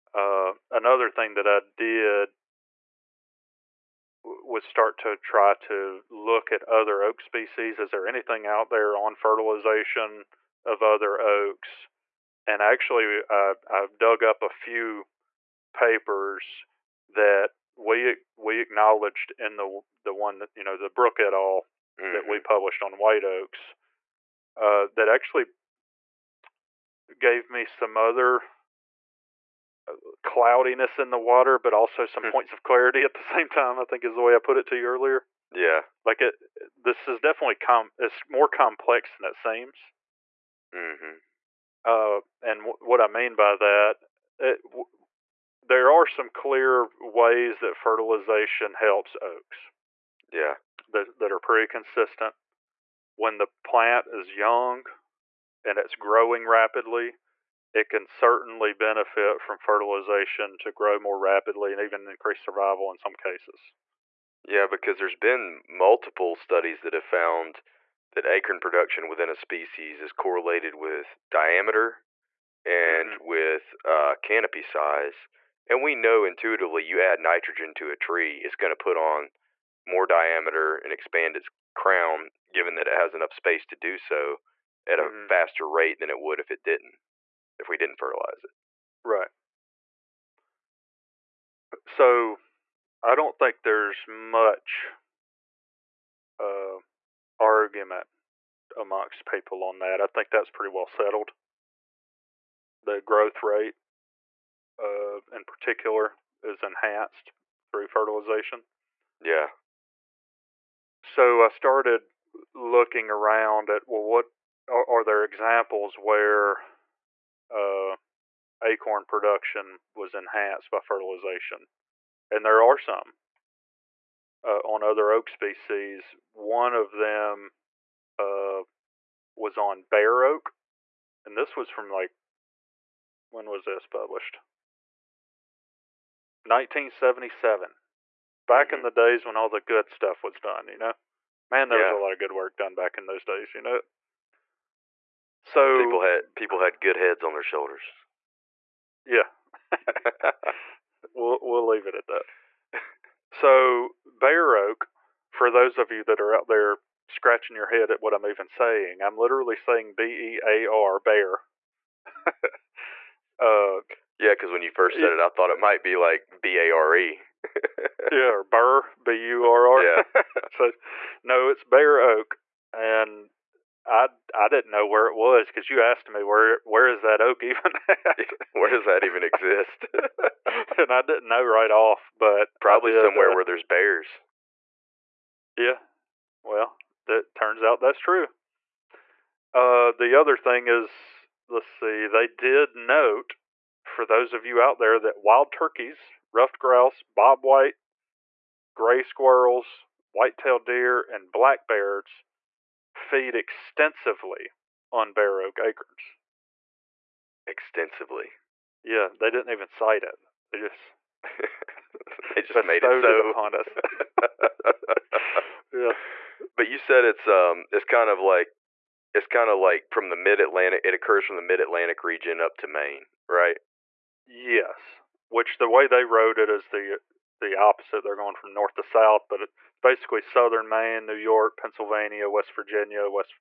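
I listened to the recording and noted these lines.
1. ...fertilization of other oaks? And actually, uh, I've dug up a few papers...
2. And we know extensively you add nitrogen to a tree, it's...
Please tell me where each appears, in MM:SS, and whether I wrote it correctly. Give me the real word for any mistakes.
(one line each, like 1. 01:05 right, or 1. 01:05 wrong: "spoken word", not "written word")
1. 00:09 right
2. 01:15 wrong: "intuitively", not "extensively".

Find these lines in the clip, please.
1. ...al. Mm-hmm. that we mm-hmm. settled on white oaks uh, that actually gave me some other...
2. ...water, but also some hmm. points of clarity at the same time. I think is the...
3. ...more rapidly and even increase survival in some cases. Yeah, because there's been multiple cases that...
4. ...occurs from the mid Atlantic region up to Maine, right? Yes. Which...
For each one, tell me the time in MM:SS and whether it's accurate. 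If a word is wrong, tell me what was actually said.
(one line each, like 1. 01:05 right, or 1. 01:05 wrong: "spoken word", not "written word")
1. 00:21 wrong: "published", not "settled"
2. 00:31 right
3. 01:00 wrong: "studies", not "cases"
4. 03:40 right.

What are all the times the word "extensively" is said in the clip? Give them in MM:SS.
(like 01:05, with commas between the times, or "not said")
03:23, 03:27.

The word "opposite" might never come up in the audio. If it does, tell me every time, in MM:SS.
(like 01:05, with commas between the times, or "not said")
03:47.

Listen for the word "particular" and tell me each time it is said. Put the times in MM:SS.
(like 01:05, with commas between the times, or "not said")
01:45.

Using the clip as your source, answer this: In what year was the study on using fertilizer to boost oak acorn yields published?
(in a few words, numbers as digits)
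1977.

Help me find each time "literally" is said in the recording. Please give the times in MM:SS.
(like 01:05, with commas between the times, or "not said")
02:39.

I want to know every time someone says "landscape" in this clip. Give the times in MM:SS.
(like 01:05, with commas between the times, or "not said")
not said.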